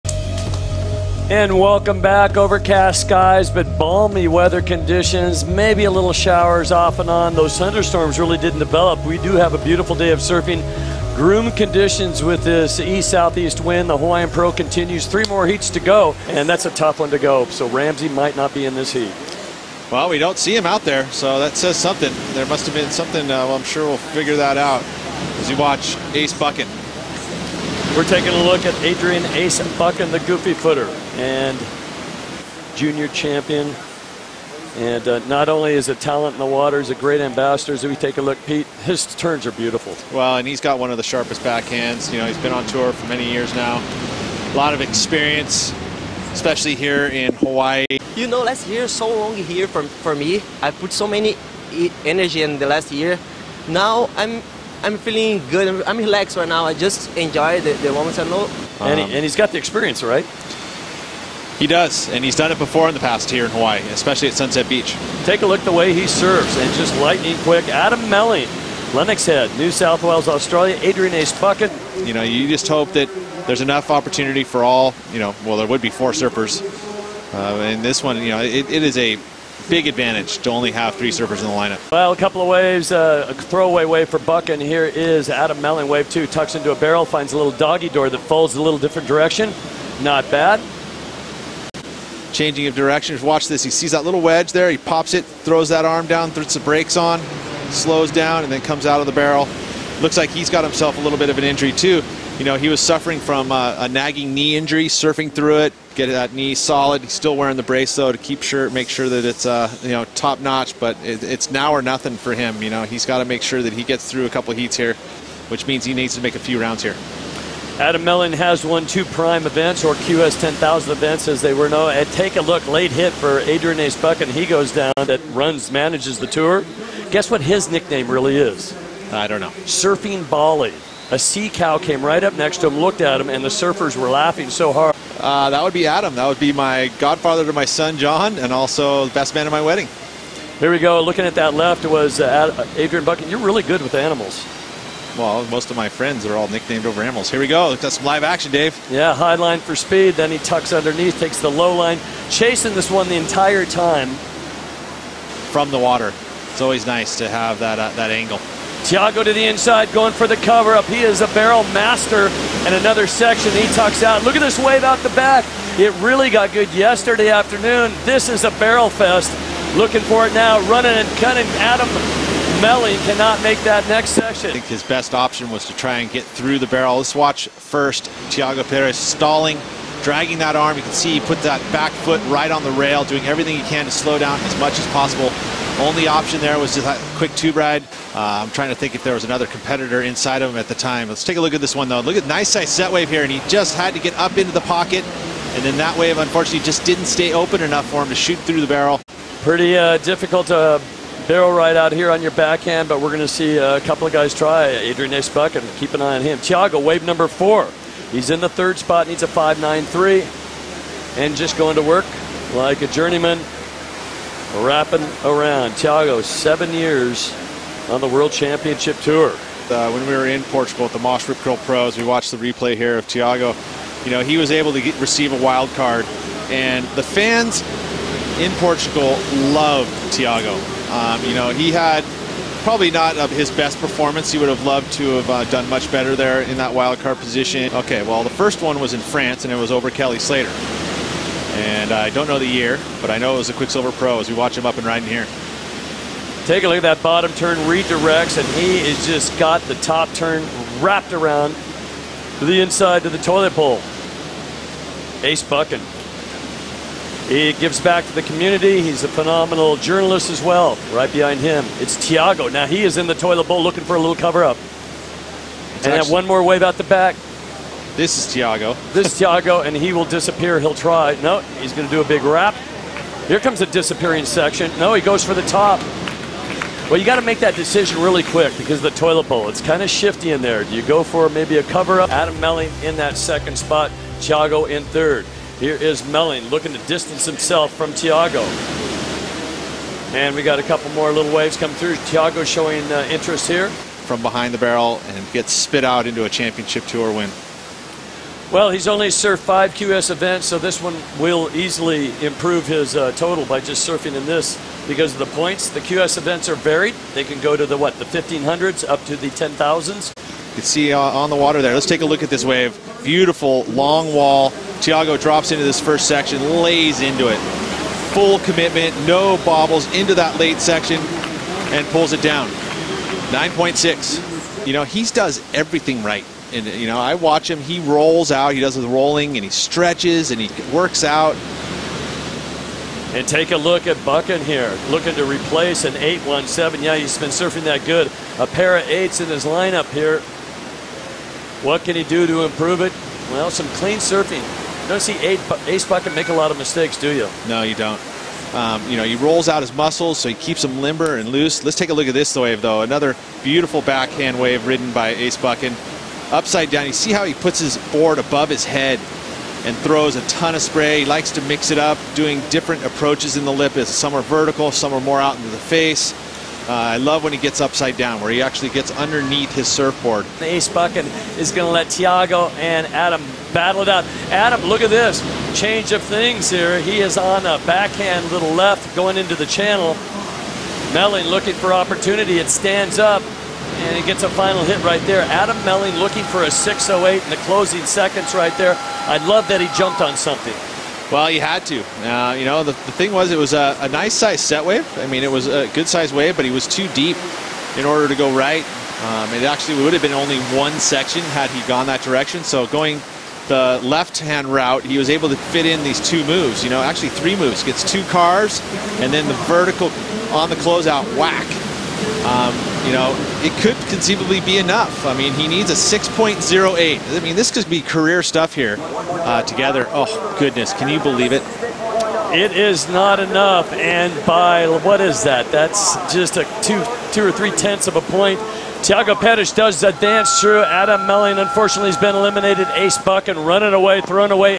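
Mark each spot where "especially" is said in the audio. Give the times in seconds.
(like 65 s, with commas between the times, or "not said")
46 s, 63 s.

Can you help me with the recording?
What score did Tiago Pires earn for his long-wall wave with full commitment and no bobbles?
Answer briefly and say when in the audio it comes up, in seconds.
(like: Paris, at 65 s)
9.6, at 323 s.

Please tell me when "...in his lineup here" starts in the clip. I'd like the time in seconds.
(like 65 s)
339 s.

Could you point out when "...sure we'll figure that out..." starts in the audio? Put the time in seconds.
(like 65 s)
23 s.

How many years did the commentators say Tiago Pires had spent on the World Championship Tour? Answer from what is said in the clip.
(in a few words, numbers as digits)
7.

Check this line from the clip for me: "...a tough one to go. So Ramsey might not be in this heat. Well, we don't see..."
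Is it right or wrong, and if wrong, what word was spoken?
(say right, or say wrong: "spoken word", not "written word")
right.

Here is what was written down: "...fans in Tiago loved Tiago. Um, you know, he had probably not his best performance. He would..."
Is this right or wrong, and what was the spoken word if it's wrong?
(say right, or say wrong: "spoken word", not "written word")
wrong: "Portugal", not "Tiago".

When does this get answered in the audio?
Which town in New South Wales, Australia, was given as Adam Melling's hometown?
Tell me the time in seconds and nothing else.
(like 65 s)
68 s.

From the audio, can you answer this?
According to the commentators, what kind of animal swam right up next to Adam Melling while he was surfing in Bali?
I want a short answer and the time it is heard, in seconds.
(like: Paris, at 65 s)
Sea cow, at 131 s.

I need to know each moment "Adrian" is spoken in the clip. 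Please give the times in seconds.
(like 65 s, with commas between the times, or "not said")
28 s, 70 s, 123 s, 142 s, 204 s.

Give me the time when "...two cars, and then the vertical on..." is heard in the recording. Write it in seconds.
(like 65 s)
407 s.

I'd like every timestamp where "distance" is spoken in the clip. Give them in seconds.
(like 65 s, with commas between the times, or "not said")
286 s.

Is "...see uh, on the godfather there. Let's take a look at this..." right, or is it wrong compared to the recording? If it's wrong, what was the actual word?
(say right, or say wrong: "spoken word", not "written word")
wrong: "water", not "godfather".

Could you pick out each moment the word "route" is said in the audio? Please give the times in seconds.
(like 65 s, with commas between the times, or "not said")
404 s.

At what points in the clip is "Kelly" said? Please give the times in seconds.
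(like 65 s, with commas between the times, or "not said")
239 s.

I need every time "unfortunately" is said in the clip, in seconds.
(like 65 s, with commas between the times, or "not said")
196 s, 431 s.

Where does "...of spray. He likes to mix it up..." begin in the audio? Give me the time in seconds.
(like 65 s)
360 s.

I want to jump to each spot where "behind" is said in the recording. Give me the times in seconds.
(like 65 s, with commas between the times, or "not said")
261 s, 294 s.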